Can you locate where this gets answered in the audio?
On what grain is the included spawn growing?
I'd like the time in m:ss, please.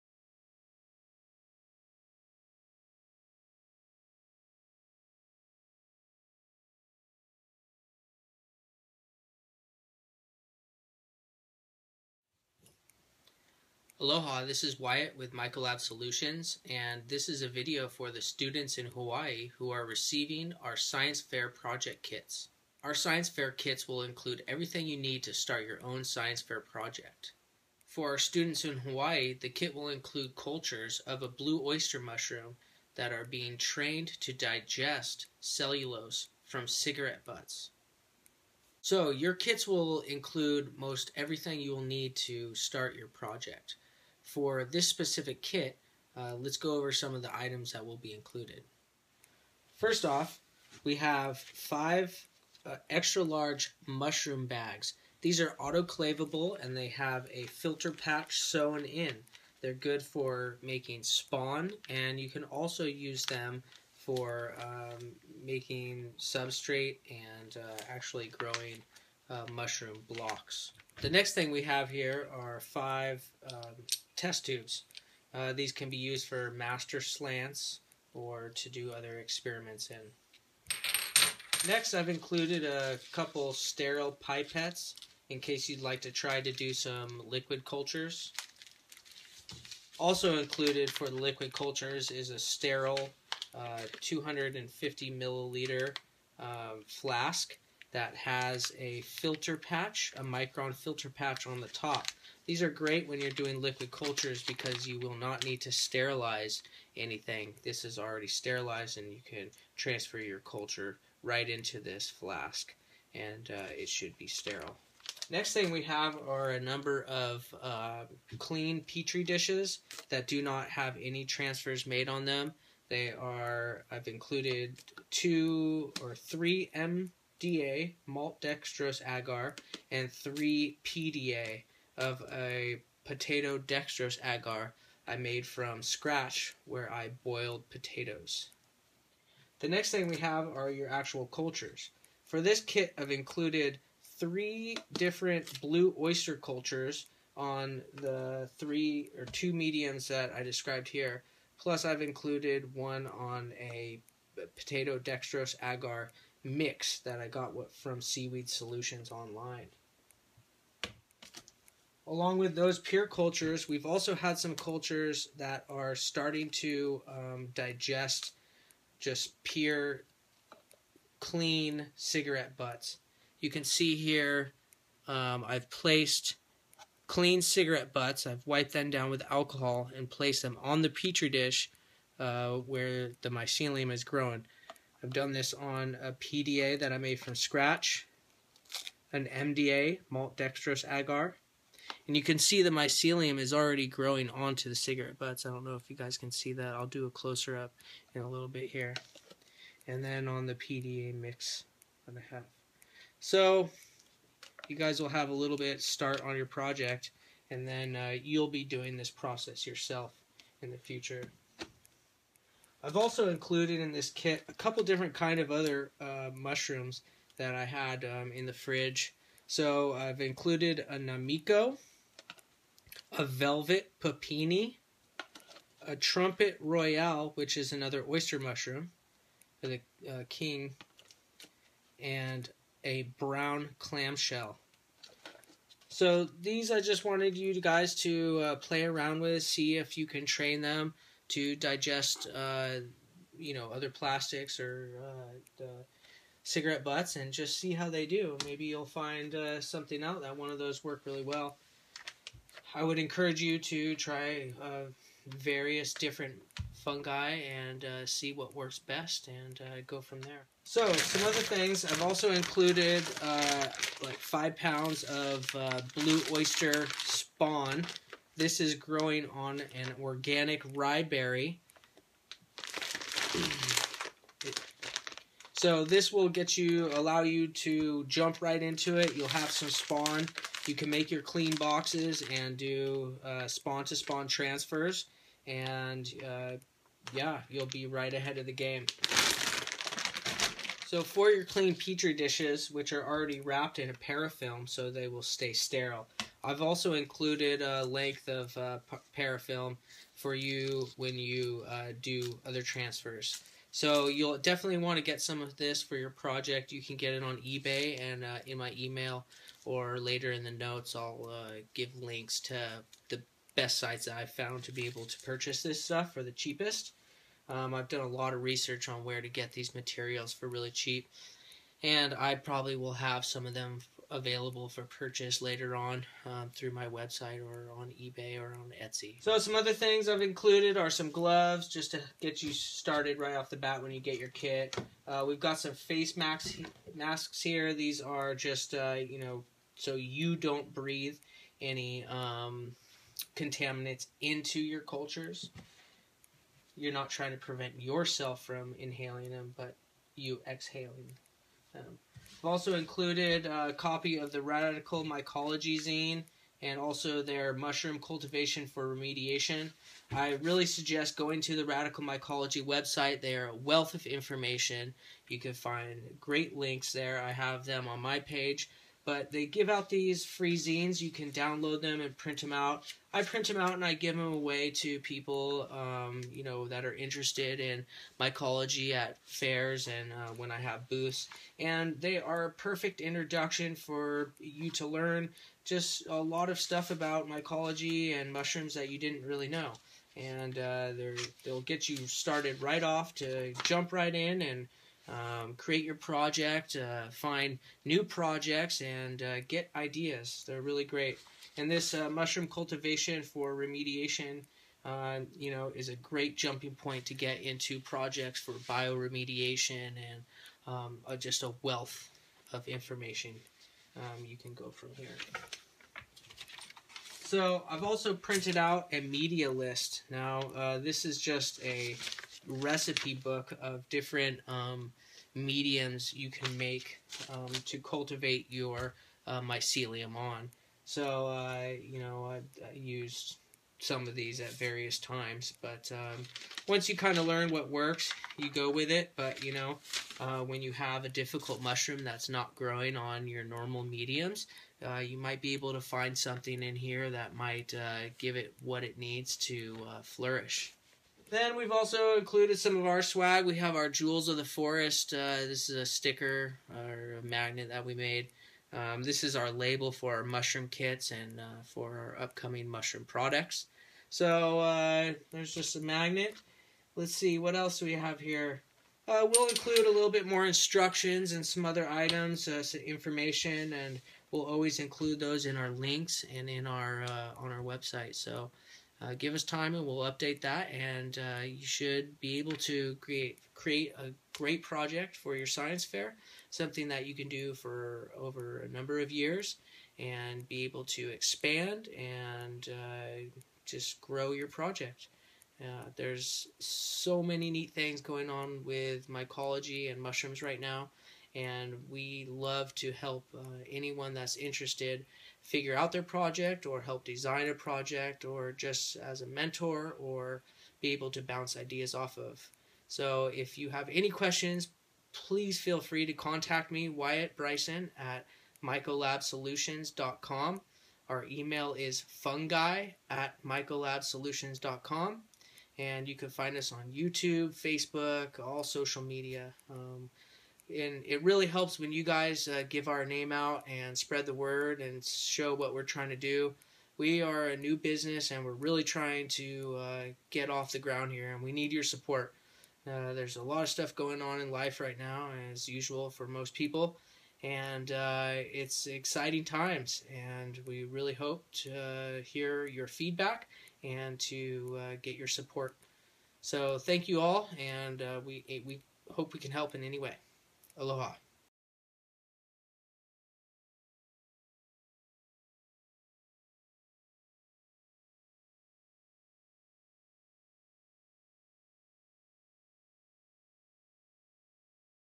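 4:30.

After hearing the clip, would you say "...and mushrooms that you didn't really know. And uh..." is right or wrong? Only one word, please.
right.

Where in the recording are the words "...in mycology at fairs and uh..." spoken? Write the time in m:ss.
6:17.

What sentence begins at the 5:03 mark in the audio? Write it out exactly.
So you'll definitely want to get some of this for your project.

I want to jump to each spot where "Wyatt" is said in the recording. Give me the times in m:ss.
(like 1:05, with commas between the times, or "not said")
0:14, 8:36.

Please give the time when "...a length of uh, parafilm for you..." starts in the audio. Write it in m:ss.
4:57.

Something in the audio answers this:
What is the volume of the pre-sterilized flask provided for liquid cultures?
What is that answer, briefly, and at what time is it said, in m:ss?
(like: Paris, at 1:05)
250 milliliters, at 1:34.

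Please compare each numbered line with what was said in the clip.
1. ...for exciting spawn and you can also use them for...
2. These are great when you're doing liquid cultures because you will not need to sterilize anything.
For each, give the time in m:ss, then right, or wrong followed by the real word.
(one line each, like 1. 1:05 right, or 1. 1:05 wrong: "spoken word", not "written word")
1. 1:00 wrong: "making", not "exciting"
2. 1:42 right.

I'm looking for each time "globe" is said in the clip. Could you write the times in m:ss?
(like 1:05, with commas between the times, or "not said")
not said.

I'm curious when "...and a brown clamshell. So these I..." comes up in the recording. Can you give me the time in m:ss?
3:52.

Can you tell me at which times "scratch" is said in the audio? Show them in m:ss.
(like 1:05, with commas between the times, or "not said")
2:15, 3:07.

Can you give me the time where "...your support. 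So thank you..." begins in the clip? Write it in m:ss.
9:15.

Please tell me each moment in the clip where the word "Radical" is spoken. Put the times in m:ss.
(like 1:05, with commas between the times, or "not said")
5:54, 6:01.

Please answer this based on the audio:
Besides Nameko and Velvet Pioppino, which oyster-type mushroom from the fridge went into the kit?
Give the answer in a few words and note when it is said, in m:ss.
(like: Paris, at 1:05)
Trumpet Royale, at 3:45.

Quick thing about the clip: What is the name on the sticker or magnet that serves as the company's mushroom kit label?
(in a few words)
Jewels of the Forest.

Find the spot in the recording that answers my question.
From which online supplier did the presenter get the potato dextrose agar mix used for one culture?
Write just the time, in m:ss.
2:38.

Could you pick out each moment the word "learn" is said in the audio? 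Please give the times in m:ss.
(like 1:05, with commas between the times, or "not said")
6:24, 7:17.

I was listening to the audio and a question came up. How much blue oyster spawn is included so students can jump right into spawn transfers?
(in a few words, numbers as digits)
5 pounds.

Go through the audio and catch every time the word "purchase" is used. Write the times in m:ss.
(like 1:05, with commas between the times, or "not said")
5:15, 5:24.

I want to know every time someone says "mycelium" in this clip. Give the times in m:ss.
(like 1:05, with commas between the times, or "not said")
3:03, 3:12, 7:09.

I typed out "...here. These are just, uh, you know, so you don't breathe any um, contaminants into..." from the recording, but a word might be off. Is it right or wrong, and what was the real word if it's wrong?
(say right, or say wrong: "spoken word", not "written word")
right.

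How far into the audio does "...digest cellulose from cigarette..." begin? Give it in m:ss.
0:34.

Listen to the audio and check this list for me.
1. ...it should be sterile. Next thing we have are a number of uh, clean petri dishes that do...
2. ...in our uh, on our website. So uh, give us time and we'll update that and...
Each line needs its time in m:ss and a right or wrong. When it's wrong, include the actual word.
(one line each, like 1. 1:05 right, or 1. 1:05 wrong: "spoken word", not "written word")
1. 1:53 right
2. 7:56 right.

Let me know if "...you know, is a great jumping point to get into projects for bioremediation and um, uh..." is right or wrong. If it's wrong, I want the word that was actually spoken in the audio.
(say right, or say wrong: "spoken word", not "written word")
right.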